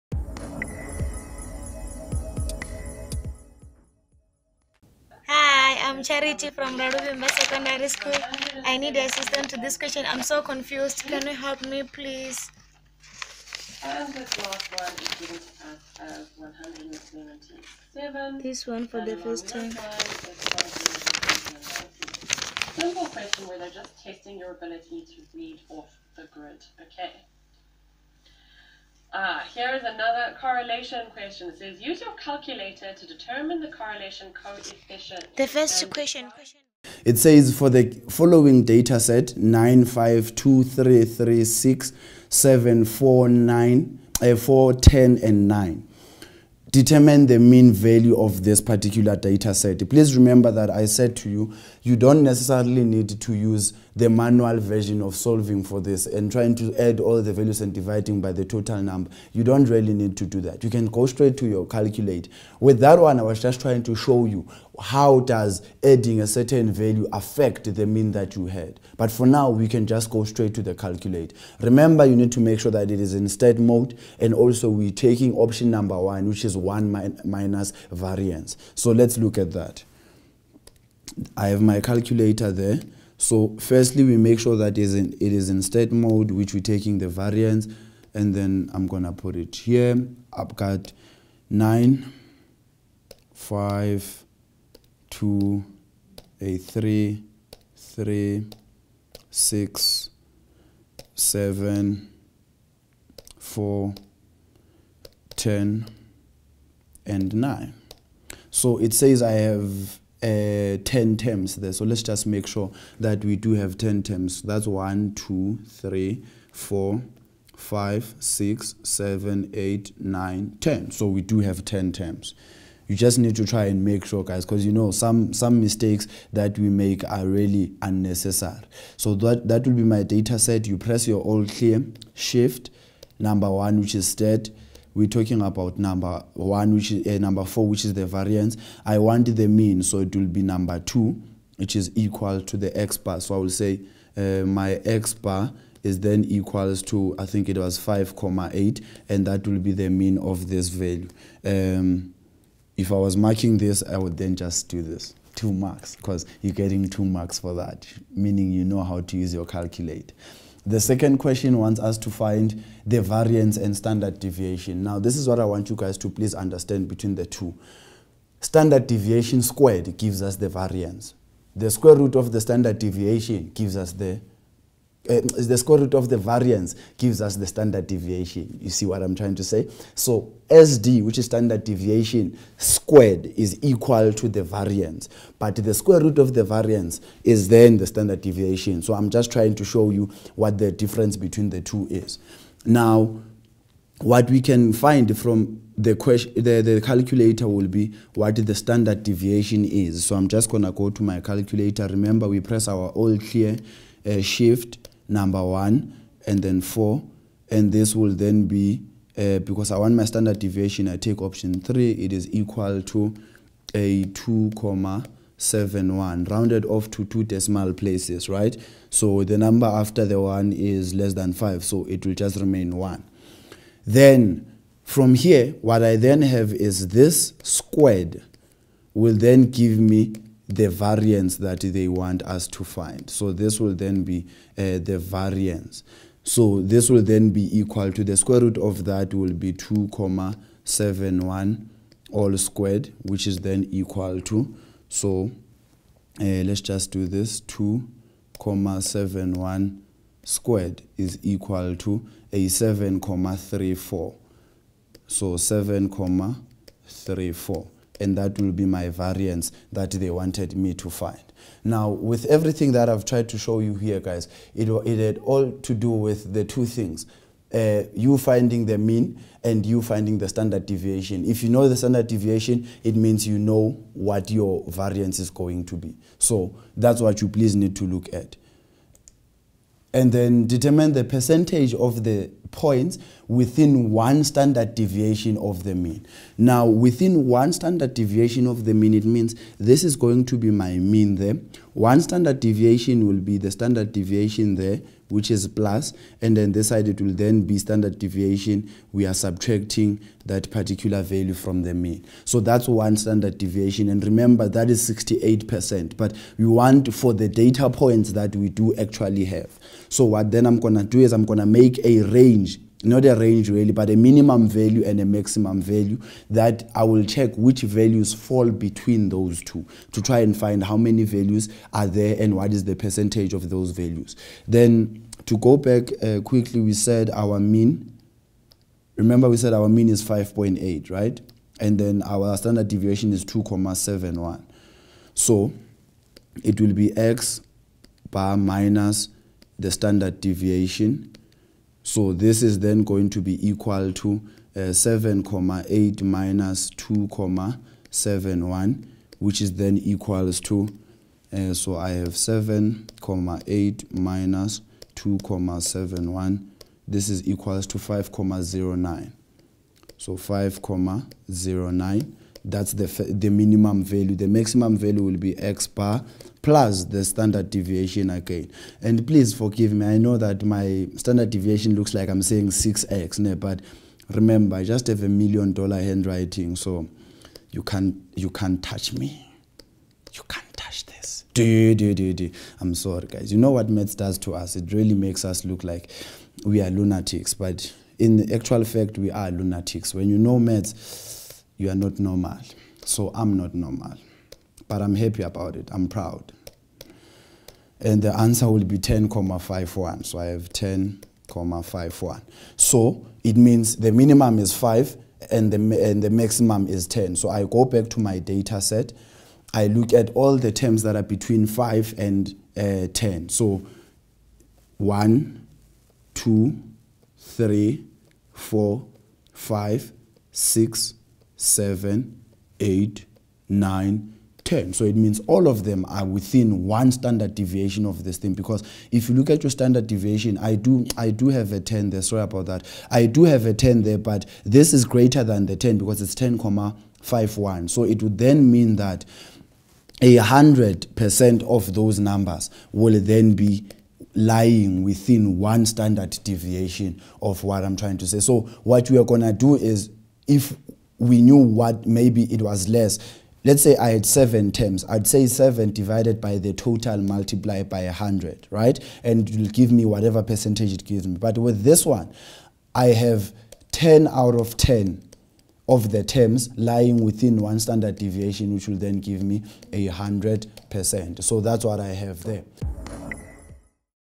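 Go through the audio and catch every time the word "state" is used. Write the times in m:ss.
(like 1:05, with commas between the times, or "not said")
1:13, 1:25, 2:14.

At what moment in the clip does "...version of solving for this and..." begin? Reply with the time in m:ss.
0:54.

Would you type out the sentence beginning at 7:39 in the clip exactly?
And it'll give me whatever percentage it gives me.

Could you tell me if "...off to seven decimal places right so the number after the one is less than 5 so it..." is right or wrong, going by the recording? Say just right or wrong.
wrong.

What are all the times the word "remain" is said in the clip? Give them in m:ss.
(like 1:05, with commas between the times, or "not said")
3:42.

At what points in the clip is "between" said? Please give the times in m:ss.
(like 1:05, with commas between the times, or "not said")
2:46, 3:11, 5:18, 6:51.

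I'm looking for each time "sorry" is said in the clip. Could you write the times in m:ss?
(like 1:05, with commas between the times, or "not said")
6:22, 7:12.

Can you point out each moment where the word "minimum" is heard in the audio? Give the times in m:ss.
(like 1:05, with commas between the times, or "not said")
5:13, 6:03, 6:43.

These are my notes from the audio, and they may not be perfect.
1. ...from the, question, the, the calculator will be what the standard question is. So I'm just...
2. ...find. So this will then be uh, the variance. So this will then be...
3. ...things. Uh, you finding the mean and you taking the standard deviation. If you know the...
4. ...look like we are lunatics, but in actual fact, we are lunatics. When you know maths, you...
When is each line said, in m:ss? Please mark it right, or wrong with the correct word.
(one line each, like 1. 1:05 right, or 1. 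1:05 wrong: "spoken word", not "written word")
1. 3:15 wrong: "deviation", not "question"
2. 3:52 right
3. 4:26 wrong: "finding", not "taking"
4. 6:25 right.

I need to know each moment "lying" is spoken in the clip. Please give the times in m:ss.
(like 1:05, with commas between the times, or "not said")
7:24, 7:46.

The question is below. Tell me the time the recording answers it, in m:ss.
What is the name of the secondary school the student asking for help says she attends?
0:06.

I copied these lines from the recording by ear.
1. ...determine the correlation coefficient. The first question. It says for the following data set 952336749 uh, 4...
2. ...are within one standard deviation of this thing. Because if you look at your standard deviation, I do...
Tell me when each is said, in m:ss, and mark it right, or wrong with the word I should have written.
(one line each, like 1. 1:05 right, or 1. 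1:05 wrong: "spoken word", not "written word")
1. 0:33 right
2. 7:05 right.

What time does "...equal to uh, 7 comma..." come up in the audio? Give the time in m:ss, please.
5:43.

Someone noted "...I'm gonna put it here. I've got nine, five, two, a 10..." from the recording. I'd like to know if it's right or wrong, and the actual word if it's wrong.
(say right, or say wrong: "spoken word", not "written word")
right.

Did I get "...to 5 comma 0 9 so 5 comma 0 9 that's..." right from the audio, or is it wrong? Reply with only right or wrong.
right.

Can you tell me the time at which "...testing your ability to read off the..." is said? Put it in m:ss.
0:24.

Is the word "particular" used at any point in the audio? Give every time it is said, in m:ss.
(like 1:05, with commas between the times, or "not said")
0:48, 5:00.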